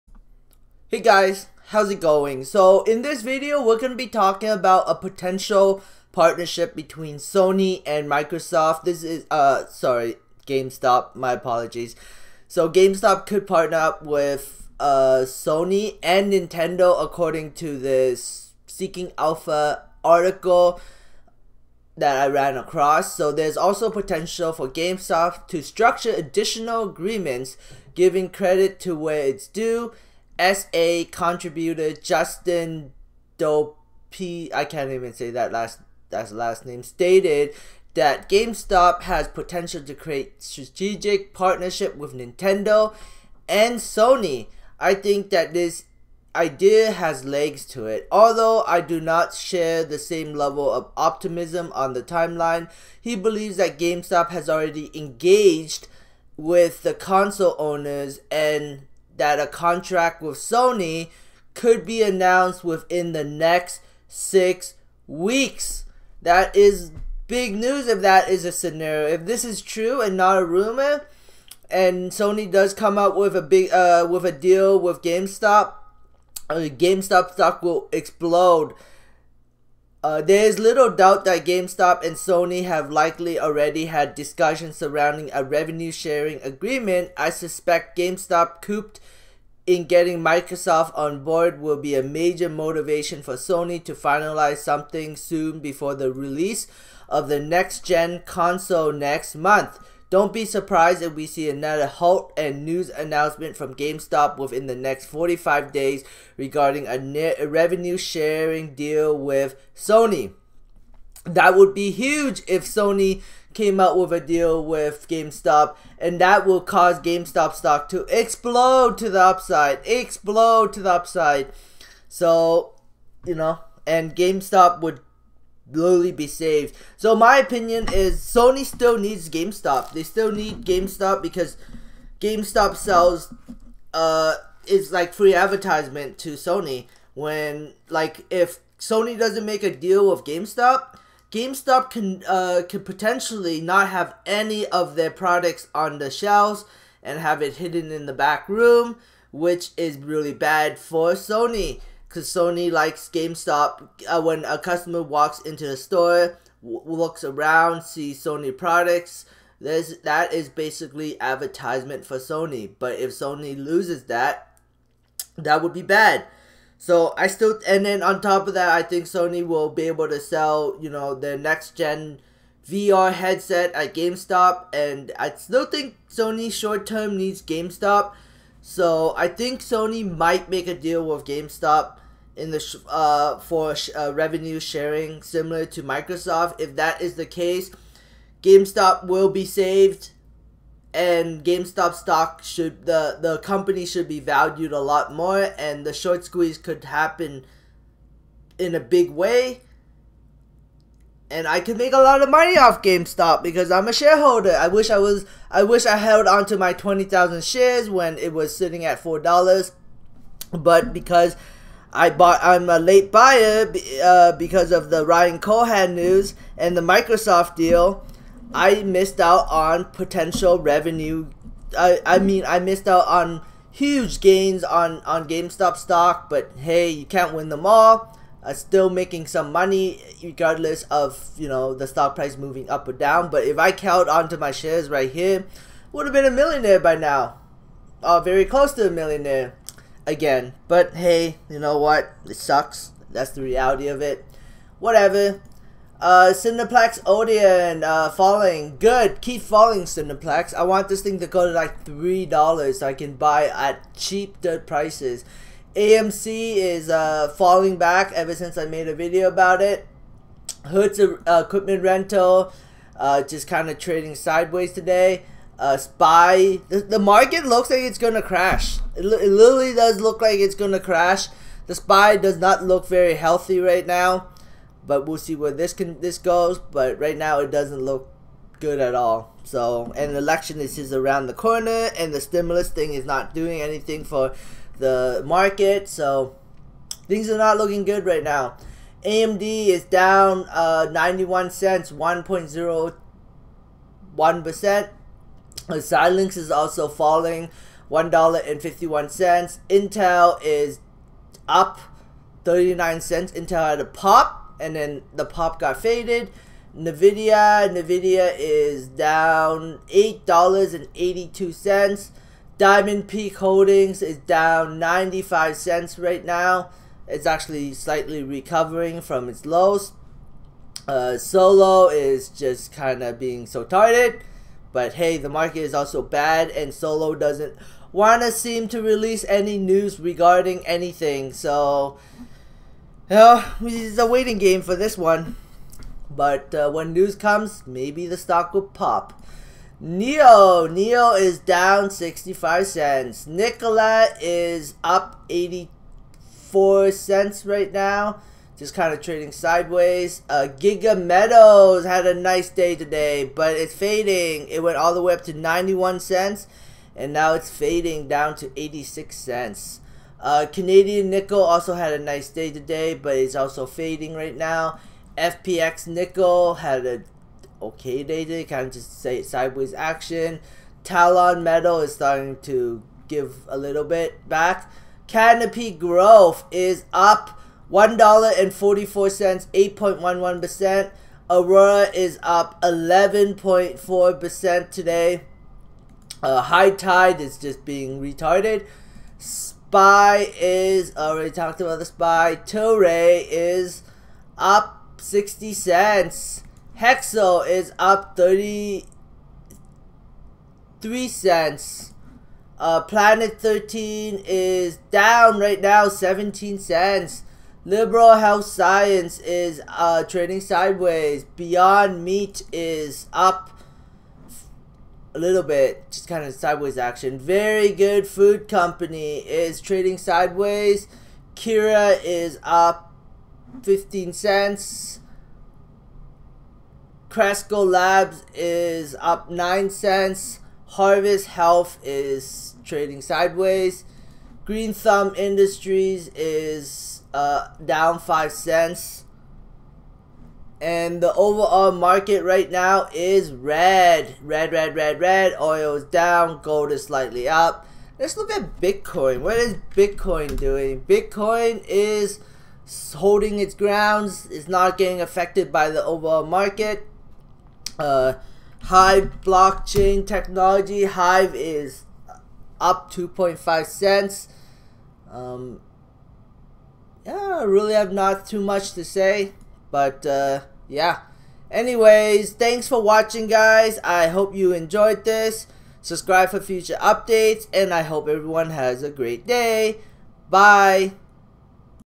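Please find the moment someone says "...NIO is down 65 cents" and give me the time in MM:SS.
05:40.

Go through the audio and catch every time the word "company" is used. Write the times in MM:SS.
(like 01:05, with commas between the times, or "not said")
03:13, 06:58.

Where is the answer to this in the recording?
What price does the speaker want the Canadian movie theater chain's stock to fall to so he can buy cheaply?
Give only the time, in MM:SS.
04:11.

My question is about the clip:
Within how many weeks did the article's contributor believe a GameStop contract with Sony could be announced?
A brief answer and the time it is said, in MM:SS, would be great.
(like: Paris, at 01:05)
6, at 01:04.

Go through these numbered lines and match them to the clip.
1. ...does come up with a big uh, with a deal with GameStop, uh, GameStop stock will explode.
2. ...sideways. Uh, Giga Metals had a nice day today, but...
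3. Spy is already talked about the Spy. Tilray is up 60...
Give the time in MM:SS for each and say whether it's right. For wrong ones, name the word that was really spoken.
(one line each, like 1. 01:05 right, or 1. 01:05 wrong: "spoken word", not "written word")
1. 01:12 right
2. 05:49 right
3. 06:29 right.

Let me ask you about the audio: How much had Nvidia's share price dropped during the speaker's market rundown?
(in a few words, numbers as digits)
$8.82.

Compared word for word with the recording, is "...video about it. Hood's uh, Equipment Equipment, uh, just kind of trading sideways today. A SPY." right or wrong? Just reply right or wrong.
wrong.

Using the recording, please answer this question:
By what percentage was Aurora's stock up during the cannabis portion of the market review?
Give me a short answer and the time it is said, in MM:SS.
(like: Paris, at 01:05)
11.4%, at 06:22.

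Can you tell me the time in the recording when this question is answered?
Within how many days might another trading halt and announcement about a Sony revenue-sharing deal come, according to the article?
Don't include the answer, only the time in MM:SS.
01:45.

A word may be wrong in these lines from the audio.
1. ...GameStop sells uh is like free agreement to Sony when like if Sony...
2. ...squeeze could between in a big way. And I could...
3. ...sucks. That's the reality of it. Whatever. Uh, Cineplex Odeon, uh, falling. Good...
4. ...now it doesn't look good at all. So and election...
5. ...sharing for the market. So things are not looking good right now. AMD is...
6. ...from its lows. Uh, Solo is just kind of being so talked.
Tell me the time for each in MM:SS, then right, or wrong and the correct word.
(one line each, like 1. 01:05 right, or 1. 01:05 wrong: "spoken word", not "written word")
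1. 02:12 wrong: "advertisement", not "agreement"
2. 03:16 wrong: "happen", not "between"
3. 04:02 right
4. 04:37 right
5. 04:43 wrong: "anything", not "sharing"
6. 05:19 wrong: "targeted", not "talked".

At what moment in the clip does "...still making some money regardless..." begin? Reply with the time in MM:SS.
03:48.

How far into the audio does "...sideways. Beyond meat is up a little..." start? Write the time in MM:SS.
06:50.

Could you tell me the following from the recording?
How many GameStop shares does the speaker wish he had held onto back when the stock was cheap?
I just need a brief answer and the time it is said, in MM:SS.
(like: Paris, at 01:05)
20,000, at 03:26.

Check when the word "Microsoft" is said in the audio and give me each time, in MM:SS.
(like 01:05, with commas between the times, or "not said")
00:08, 01:30, 03:05, 03:36.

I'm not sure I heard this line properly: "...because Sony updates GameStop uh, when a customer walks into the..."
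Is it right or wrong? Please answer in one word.
wrong.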